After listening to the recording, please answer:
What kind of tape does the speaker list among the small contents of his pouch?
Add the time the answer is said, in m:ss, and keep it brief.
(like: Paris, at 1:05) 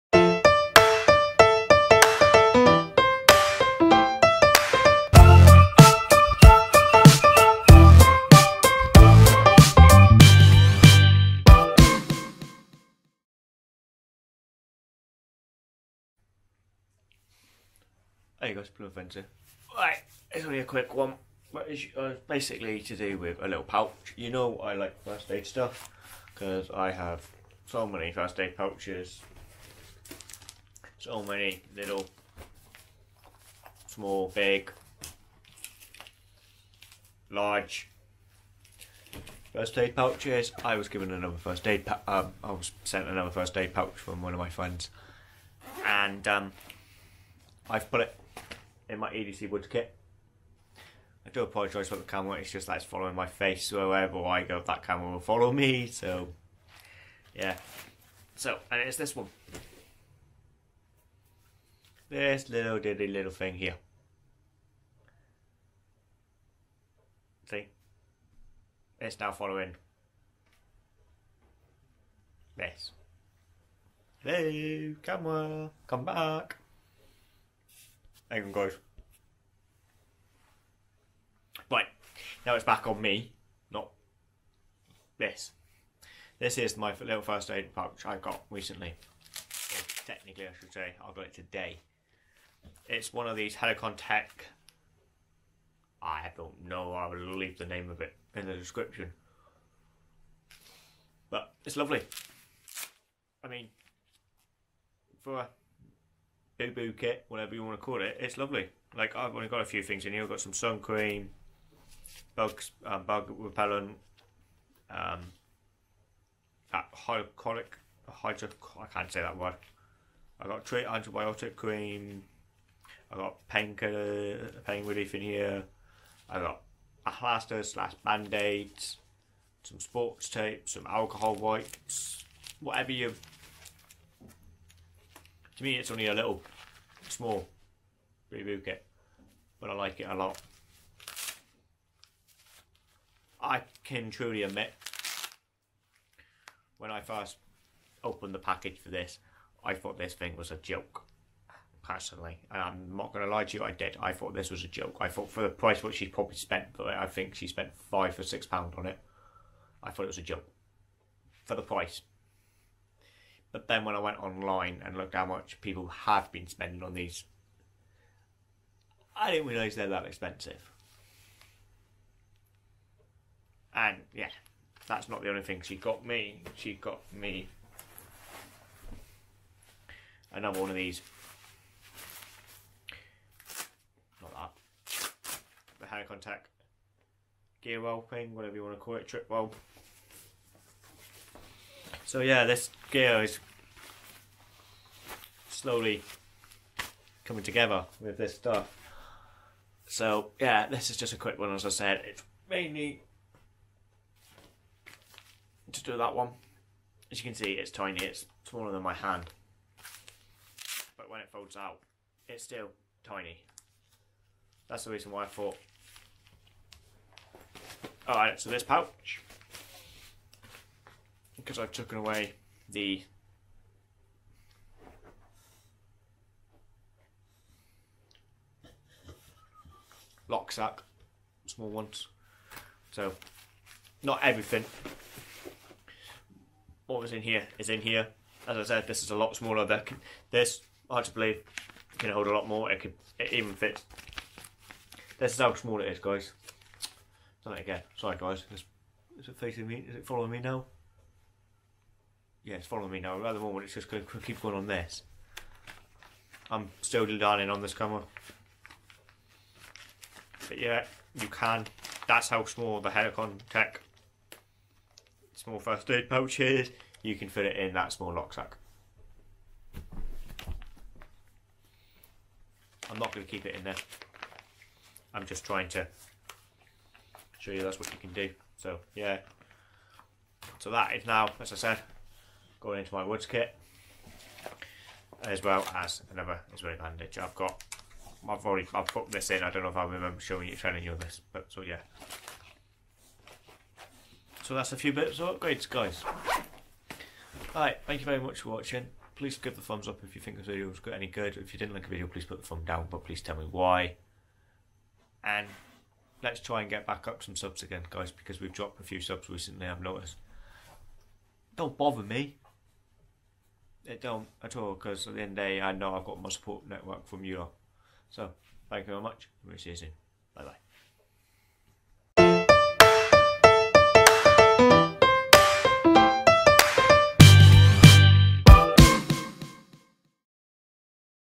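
sports tape, at 2:09.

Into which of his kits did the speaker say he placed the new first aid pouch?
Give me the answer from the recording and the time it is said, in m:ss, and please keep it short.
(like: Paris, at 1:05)
EDC Woods kit, at 0:49.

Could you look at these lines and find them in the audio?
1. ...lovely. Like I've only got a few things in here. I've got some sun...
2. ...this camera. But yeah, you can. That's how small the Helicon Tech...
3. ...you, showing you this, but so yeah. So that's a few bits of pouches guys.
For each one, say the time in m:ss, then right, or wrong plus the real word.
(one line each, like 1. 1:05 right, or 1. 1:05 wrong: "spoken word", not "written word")
1. 1:48 right
2. 4:17 right
3. 4:50 wrong: "upgrades", not "pouches".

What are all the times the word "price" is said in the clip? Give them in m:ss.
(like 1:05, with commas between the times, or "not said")
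2:35, 2:41.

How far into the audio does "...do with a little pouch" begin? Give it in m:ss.
0:22.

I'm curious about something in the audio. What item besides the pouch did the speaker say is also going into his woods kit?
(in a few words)
Israeli bandage.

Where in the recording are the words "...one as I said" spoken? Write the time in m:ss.
3:21.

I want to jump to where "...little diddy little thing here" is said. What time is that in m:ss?
1:02.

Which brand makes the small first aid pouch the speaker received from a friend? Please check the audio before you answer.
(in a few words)
Helikon-Tex.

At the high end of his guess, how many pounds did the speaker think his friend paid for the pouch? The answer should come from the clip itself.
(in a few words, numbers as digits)
6 pounds.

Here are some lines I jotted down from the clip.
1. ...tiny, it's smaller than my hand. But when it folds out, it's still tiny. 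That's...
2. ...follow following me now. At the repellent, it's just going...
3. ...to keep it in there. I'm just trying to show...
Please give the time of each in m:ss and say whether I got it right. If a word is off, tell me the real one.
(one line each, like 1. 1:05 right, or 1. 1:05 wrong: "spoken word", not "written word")
1. 3:27 right
2. 4:12 wrong: "moment", not "repellent"
3. 4:33 right.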